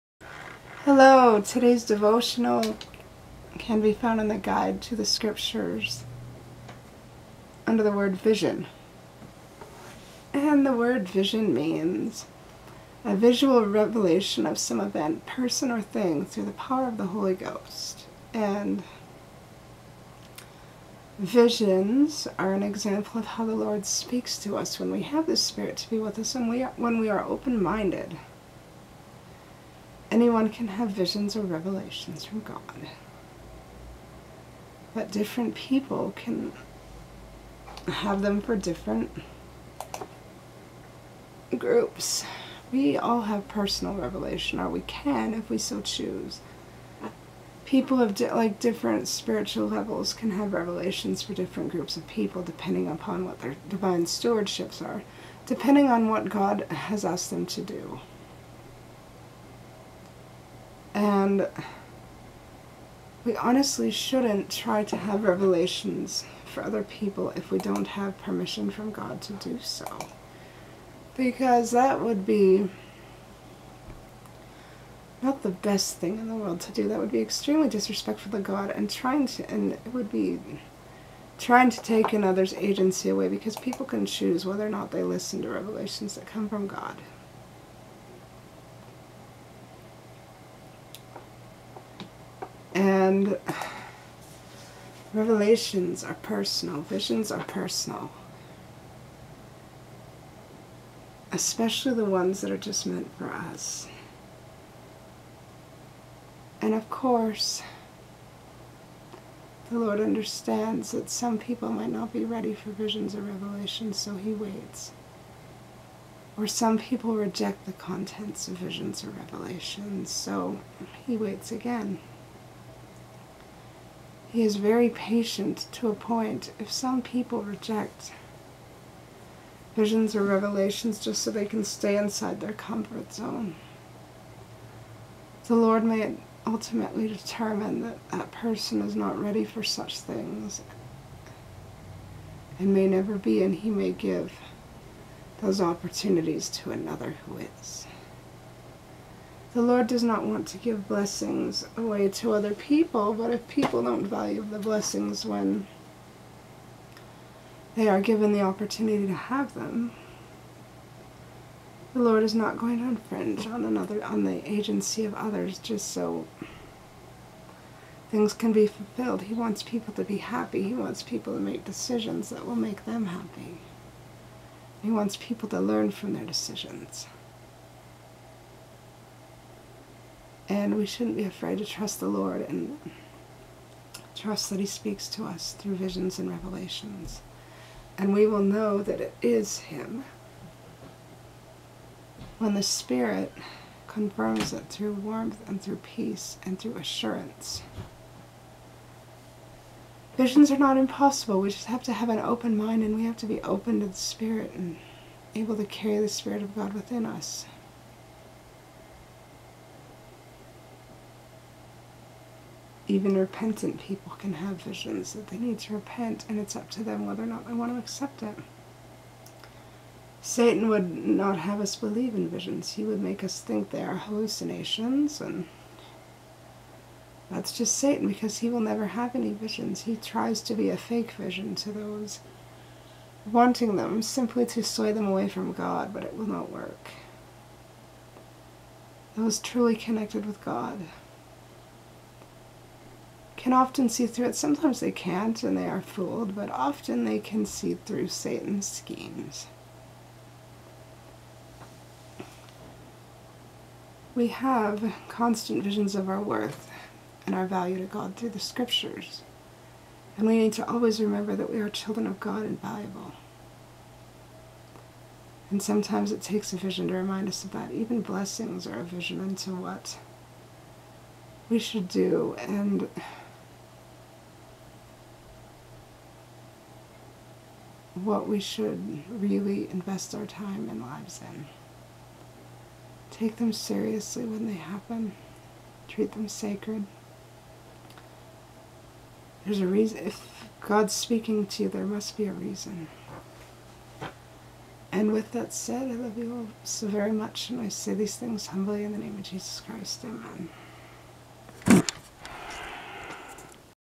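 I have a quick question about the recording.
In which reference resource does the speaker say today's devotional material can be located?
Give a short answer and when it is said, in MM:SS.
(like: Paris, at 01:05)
Guide to the Scriptures, at 00:04.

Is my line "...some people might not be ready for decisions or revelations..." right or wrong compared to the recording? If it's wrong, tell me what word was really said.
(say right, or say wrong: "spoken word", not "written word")
wrong: "visions", not "decisions".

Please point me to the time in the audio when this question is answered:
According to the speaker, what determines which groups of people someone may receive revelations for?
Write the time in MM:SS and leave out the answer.
00:53.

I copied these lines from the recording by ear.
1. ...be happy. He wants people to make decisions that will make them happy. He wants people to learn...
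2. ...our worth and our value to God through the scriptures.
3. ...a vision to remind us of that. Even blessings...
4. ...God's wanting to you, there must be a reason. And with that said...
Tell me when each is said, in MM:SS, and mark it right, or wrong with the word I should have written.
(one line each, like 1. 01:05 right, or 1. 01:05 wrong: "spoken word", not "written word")
1. 02:50 right
2. 04:16 right
3. 04:26 right
4. 04:50 wrong: "speaking", not "wanting".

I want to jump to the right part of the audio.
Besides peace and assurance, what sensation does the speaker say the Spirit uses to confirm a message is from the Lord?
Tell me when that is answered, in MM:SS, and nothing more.
03:14.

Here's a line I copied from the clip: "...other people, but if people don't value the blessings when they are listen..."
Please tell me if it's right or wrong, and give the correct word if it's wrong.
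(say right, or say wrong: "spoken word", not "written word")
wrong: "given", not "listen".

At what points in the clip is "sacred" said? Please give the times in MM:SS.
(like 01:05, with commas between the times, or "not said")
04:46.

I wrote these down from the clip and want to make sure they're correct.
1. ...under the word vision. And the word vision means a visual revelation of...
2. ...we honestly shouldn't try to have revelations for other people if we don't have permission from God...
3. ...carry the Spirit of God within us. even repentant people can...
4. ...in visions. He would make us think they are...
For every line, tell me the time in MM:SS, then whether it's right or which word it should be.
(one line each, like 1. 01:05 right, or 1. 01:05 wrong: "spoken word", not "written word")
1. 00:07 right
2. 01:03 right
3. 03:25 right
4. 03:42 right.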